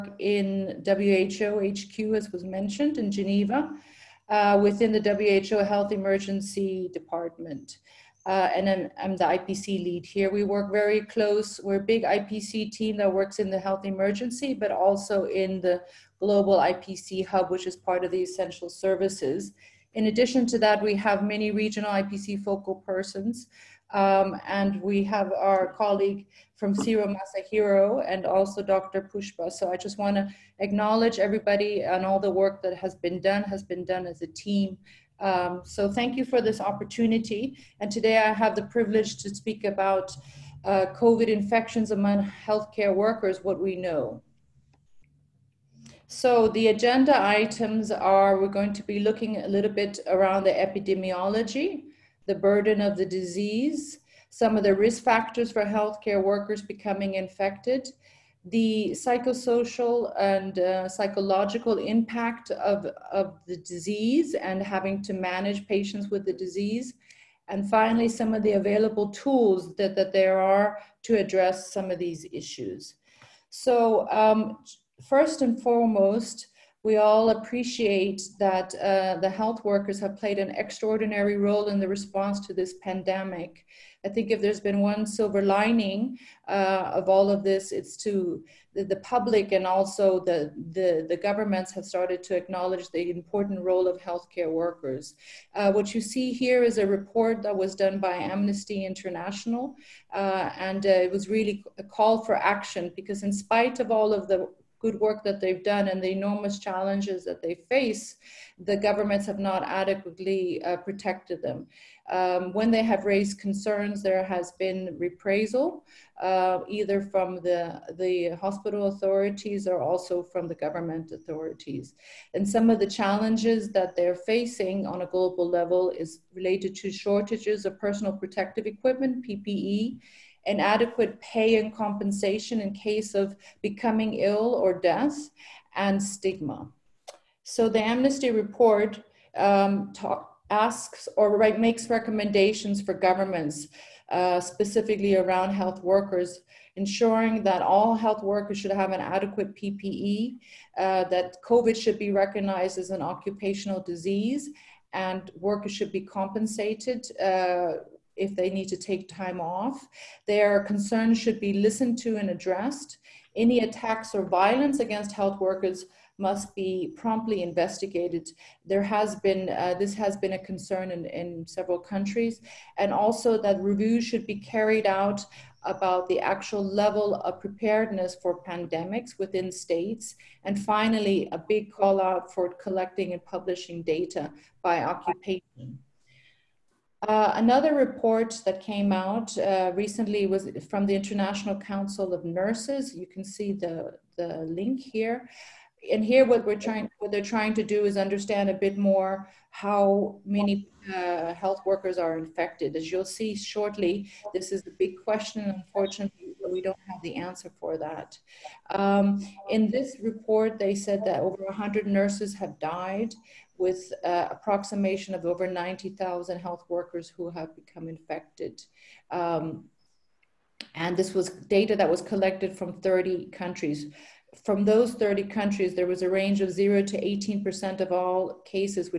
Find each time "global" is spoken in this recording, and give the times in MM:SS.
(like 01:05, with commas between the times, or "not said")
00:16, 02:05.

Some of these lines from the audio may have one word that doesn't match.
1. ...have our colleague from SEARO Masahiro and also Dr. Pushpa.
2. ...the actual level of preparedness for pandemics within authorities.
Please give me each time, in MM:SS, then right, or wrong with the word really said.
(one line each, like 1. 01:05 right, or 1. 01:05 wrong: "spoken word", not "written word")
1. 00:25 right
2. 02:56 wrong: "states", not "authorities".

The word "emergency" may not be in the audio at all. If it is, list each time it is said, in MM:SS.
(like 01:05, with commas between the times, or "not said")
00:05, 00:13.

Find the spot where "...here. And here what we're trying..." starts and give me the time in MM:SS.
03:14.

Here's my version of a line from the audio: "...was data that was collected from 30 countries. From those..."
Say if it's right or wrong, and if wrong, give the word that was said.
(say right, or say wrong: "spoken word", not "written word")
right.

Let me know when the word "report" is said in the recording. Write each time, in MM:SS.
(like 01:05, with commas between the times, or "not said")
01:36, 02:18, 03:07, 03:29.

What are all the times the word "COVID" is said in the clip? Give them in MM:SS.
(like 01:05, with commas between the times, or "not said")
00:41, 02:31.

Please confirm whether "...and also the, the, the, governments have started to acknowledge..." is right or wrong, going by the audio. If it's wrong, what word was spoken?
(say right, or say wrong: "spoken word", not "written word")
right.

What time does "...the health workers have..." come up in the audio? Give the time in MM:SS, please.
01:19.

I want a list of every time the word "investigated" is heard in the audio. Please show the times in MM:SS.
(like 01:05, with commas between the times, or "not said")
02:47.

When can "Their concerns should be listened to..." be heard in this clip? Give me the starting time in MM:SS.
02:40.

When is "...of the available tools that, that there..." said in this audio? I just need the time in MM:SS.
01:08.